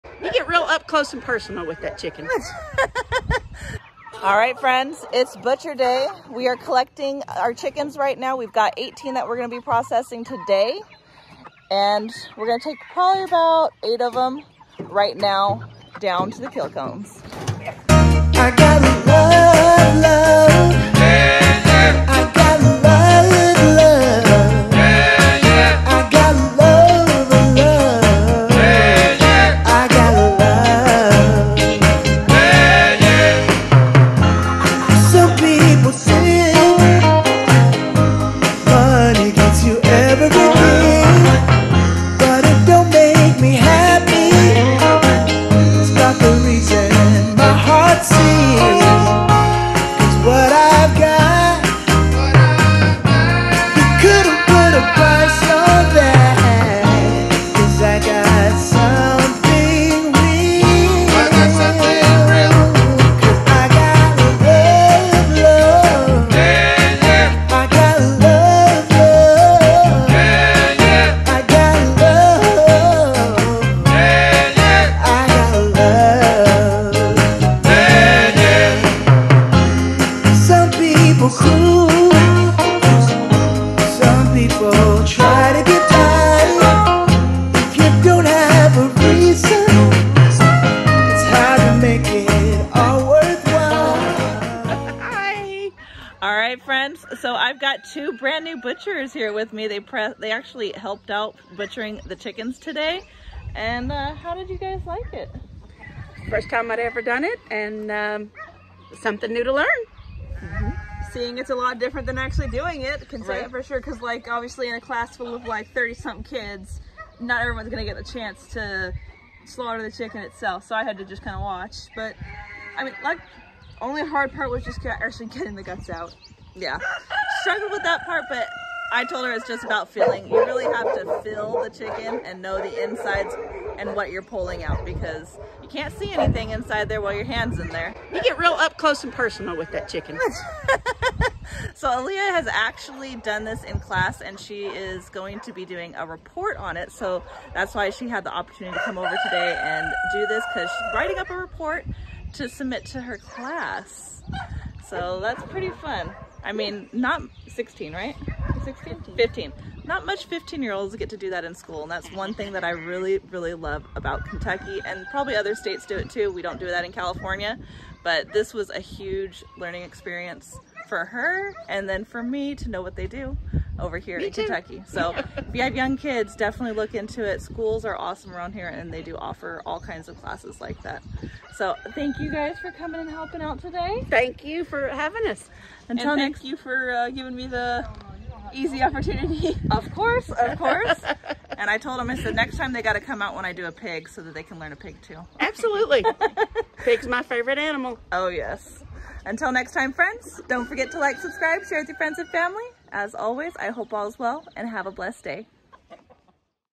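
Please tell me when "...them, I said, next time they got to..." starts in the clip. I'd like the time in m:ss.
3:11.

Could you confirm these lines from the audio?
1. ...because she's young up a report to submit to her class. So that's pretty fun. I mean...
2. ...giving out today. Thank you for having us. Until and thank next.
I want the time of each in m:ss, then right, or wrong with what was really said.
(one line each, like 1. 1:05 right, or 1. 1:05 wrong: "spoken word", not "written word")
1. 2:30 wrong: "writing", not "young"
2. 3:03 wrong: "helping", not "giving".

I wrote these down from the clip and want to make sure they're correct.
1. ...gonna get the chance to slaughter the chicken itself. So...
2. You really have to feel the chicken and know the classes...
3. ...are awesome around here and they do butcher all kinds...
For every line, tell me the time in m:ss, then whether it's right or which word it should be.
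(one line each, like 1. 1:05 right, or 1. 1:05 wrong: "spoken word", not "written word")
1. 1:57 right
2. 2:10 wrong: "insides", not "classes"
3. 2:57 wrong: "offer", not "butcher".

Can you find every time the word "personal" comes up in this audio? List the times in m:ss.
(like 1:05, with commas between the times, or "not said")
0:01, 2:19.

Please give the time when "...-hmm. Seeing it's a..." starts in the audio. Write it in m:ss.
1:50.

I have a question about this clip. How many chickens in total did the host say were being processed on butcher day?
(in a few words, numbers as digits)
18.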